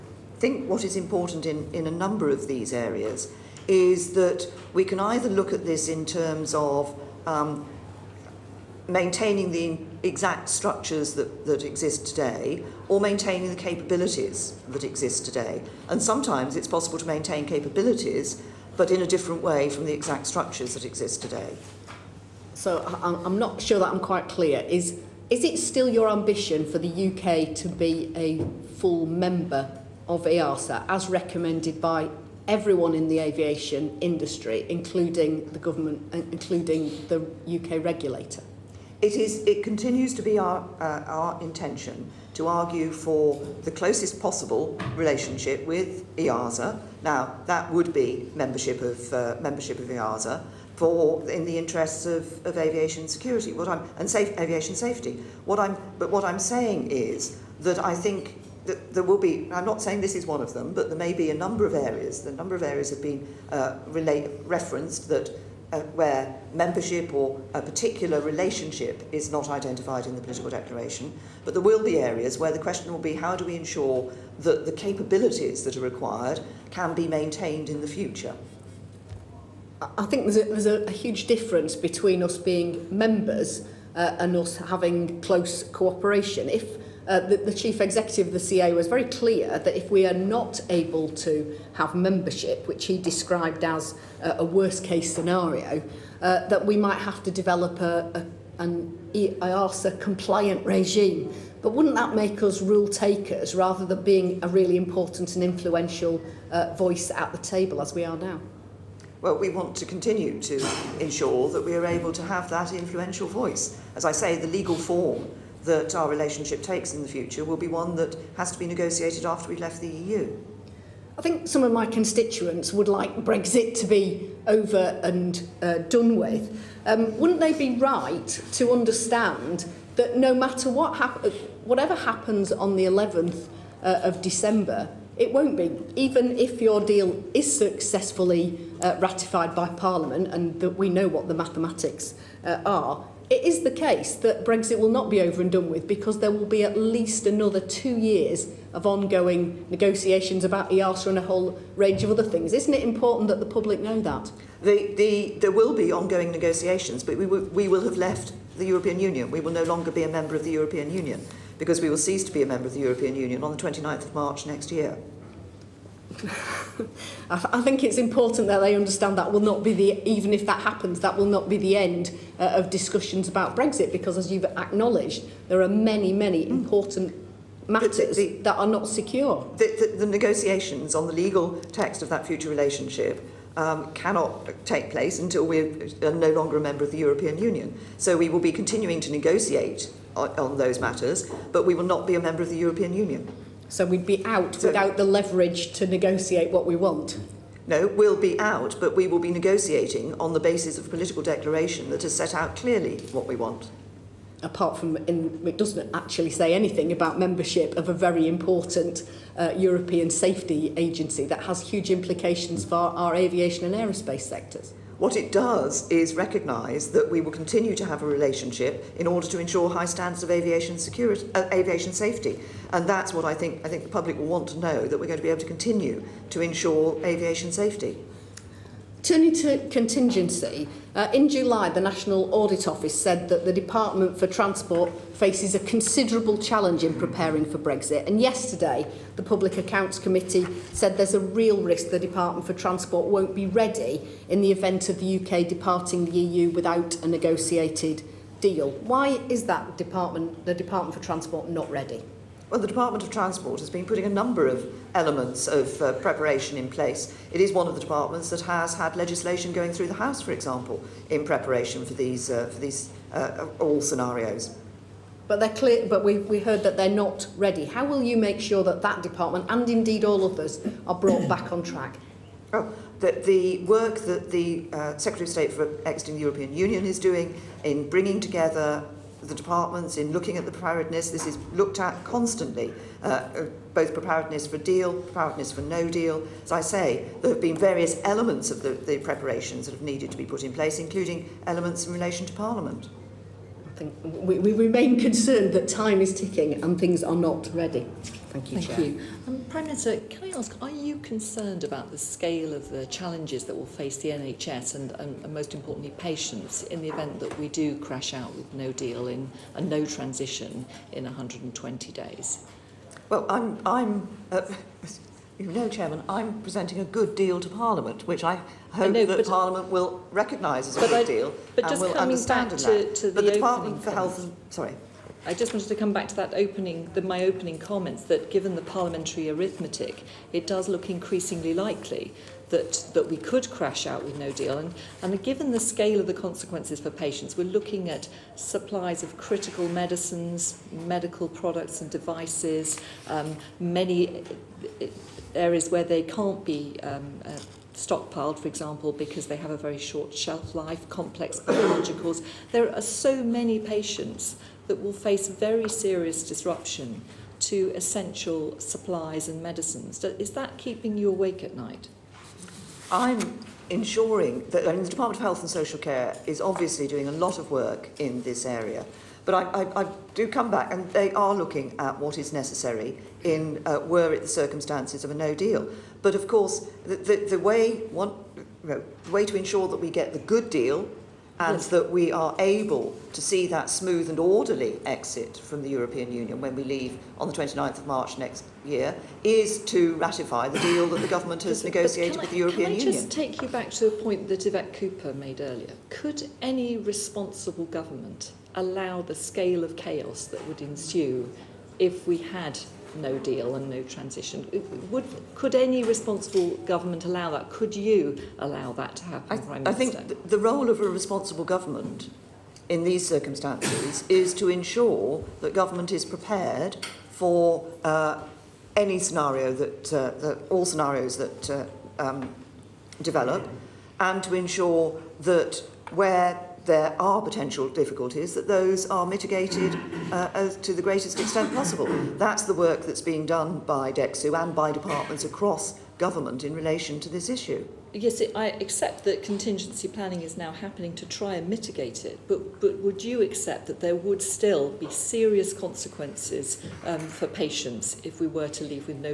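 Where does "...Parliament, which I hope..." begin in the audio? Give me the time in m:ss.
5:17.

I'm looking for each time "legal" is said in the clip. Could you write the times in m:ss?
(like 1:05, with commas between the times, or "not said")
1:54, 3:01.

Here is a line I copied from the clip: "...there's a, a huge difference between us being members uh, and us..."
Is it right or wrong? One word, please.
right.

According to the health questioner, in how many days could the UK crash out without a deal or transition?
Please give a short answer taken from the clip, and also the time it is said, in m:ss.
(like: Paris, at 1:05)
120 days, at 5:11.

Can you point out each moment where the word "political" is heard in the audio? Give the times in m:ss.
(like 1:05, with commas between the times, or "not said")
1:10, 3:20.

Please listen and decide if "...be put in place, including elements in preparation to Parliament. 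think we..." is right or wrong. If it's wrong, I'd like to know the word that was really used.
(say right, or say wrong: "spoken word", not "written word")
wrong: "relation", not "preparation".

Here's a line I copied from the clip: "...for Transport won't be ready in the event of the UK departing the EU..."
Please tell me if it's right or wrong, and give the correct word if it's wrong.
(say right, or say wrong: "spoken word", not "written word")
right.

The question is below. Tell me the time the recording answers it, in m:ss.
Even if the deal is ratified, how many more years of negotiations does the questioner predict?
2:27.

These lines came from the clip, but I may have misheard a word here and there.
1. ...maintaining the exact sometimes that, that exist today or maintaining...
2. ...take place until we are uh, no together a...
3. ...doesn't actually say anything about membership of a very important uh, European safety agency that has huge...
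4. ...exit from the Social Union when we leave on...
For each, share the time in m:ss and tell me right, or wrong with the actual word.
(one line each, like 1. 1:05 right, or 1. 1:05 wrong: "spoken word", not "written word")
1. 0:08 wrong: "structures", not "sometimes"
2. 3:04 wrong: "longer", not "together"
3. 3:25 right
4. 6:24 wrong: "European", not "Social".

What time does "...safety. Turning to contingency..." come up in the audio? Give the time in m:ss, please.
3:47.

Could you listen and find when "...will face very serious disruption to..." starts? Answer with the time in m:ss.
5:54.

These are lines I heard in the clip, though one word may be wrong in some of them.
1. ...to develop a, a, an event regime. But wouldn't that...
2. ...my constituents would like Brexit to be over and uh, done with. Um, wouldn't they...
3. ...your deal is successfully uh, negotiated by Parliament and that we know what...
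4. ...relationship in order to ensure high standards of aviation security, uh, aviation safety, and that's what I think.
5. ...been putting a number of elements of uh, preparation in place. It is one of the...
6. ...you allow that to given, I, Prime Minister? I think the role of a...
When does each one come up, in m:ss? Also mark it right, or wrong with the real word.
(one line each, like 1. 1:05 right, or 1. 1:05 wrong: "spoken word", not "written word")
1. 1:37 wrong: "compliant", not "event"
2. 2:01 right
3. 2:16 wrong: "ratified", not "negotiated"
4. 3:38 right
5. 4:13 right
6. 6:47 wrong: "happen", not "given".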